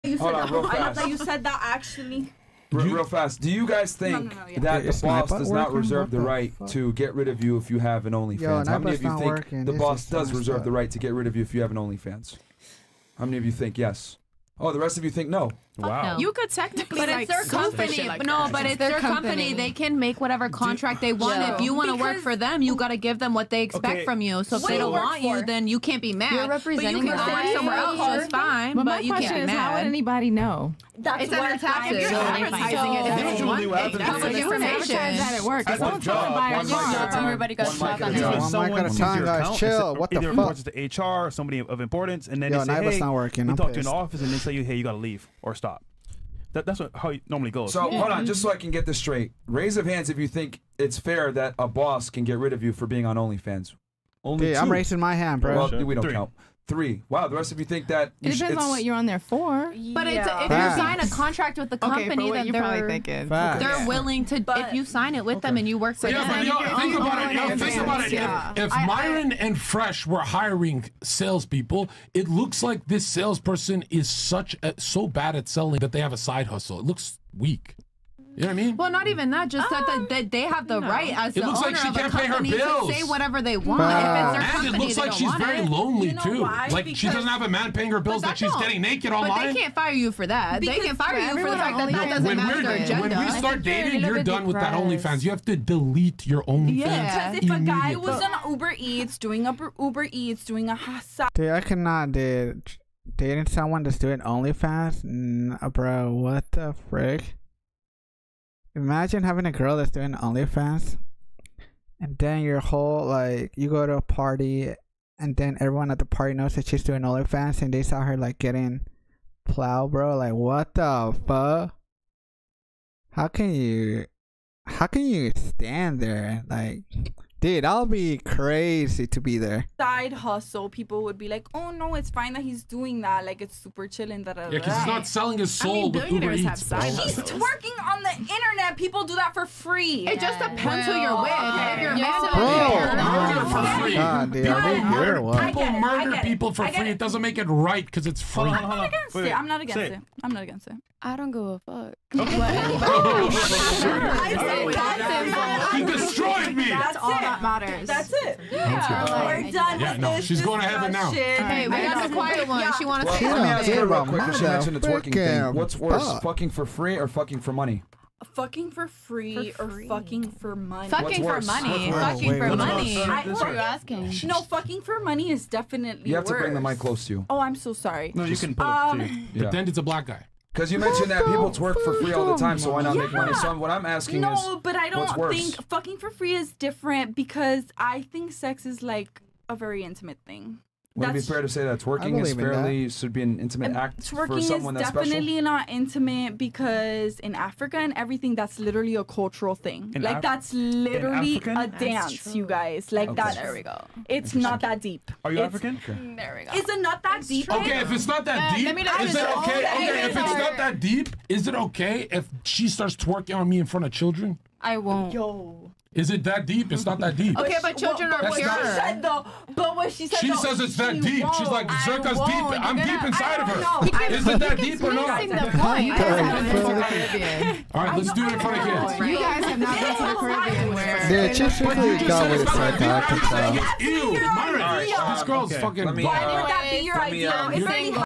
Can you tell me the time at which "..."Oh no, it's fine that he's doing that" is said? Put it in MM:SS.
02:11.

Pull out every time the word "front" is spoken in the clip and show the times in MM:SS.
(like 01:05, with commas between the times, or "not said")
03:33, 03:48.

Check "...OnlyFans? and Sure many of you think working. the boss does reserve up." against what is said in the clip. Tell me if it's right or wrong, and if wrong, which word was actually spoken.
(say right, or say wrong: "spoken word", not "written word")
wrong: "How", not "Sure".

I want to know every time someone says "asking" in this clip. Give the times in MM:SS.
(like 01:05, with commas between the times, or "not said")
02:53, 03:03.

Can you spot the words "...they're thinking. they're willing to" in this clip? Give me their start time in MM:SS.
01:02.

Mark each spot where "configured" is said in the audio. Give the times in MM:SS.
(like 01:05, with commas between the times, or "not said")
not said.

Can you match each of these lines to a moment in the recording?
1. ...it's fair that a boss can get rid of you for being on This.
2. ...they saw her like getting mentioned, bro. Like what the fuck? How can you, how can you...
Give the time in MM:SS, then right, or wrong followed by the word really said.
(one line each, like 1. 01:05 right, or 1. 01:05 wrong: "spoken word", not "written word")
1. 00:50 wrong: "OnlyFans", not "This"
2. 01:57 wrong: "plowed", not "mentioned".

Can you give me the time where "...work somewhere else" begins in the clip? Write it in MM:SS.
00:27.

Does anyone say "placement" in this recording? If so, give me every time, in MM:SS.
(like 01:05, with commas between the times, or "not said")
not said.